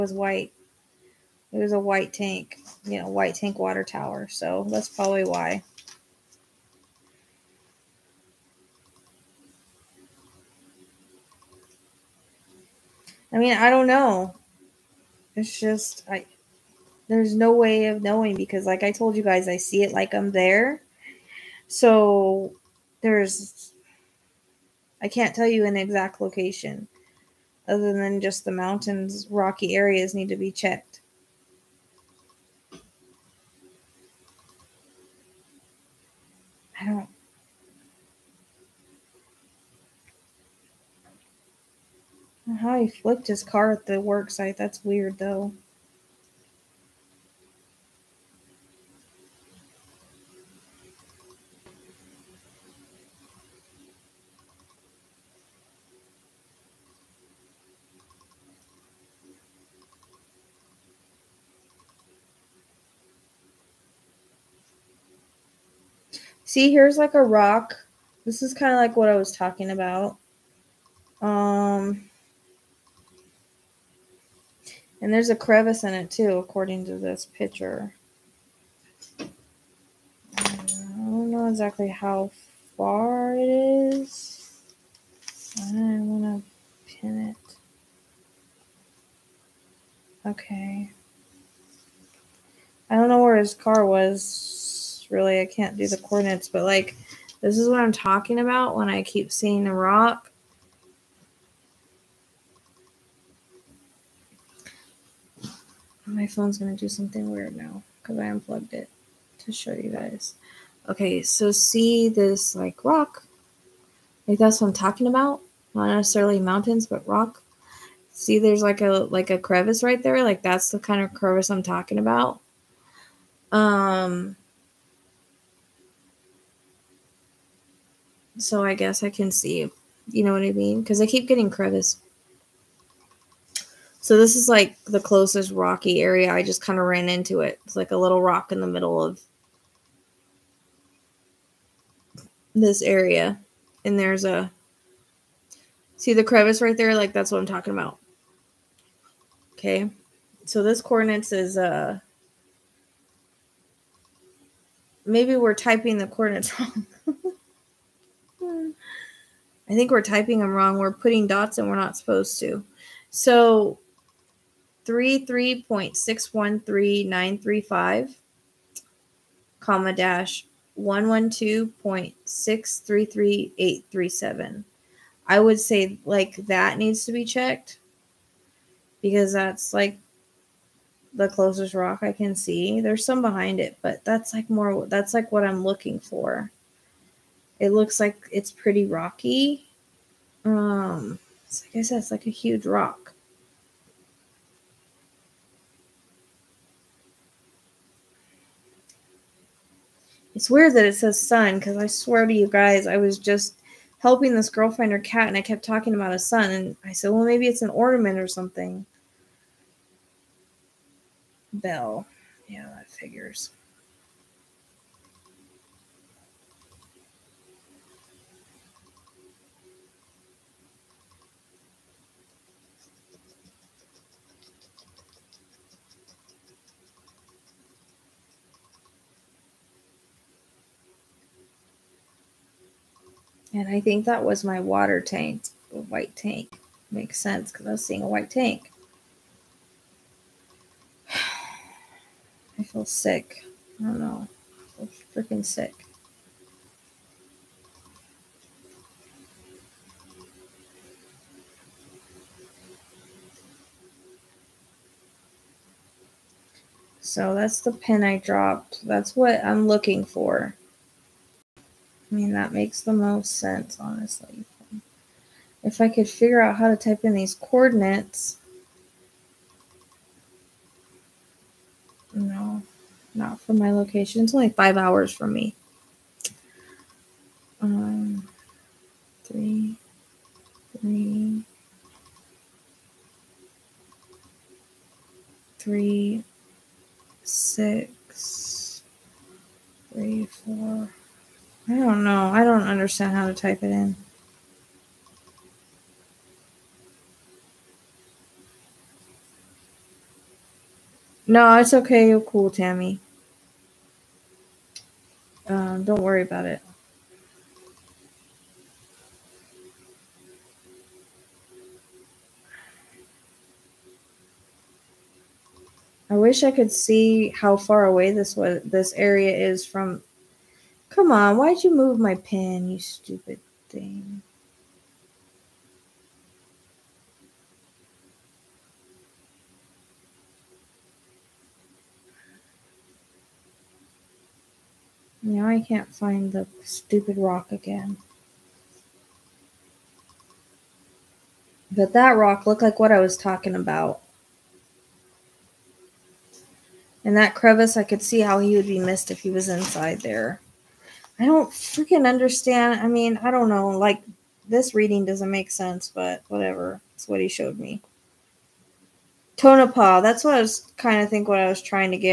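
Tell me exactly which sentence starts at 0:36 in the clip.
I don't How he flipped his car at the work site.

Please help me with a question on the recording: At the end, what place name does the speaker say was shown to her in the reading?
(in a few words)
Tonopah.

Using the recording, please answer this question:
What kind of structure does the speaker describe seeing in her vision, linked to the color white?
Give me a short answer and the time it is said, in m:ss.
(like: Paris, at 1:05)
water tower, at 0:03.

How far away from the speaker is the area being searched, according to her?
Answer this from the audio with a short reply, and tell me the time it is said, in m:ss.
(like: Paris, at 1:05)
5 hours, at 4:34.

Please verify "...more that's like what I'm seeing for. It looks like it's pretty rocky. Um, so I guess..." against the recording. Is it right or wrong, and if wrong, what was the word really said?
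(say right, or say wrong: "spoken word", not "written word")
wrong: "looking", not "seeing".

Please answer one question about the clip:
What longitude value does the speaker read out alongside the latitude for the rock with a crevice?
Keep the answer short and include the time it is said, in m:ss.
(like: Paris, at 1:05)
-112.633837, at 2:49.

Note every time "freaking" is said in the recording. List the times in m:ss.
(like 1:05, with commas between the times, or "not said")
4:05, 5:51.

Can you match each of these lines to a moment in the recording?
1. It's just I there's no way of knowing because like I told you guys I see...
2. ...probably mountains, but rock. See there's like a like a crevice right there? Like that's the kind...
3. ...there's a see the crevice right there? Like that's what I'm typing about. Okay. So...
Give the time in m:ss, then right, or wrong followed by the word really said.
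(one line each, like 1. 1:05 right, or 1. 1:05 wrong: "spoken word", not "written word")
1. 0:15 right
2. 1:55 wrong: "necessarily", not "probably"
3. 2:23 wrong: "talking", not "typing".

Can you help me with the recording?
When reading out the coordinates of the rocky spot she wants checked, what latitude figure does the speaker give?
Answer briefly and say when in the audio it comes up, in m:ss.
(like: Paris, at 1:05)
33.613935, at 2:44.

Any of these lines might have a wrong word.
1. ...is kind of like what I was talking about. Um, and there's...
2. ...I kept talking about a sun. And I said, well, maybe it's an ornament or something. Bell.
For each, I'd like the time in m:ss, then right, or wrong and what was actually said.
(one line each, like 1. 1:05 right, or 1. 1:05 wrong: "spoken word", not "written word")
1. 1:08 right
2. 3:25 right.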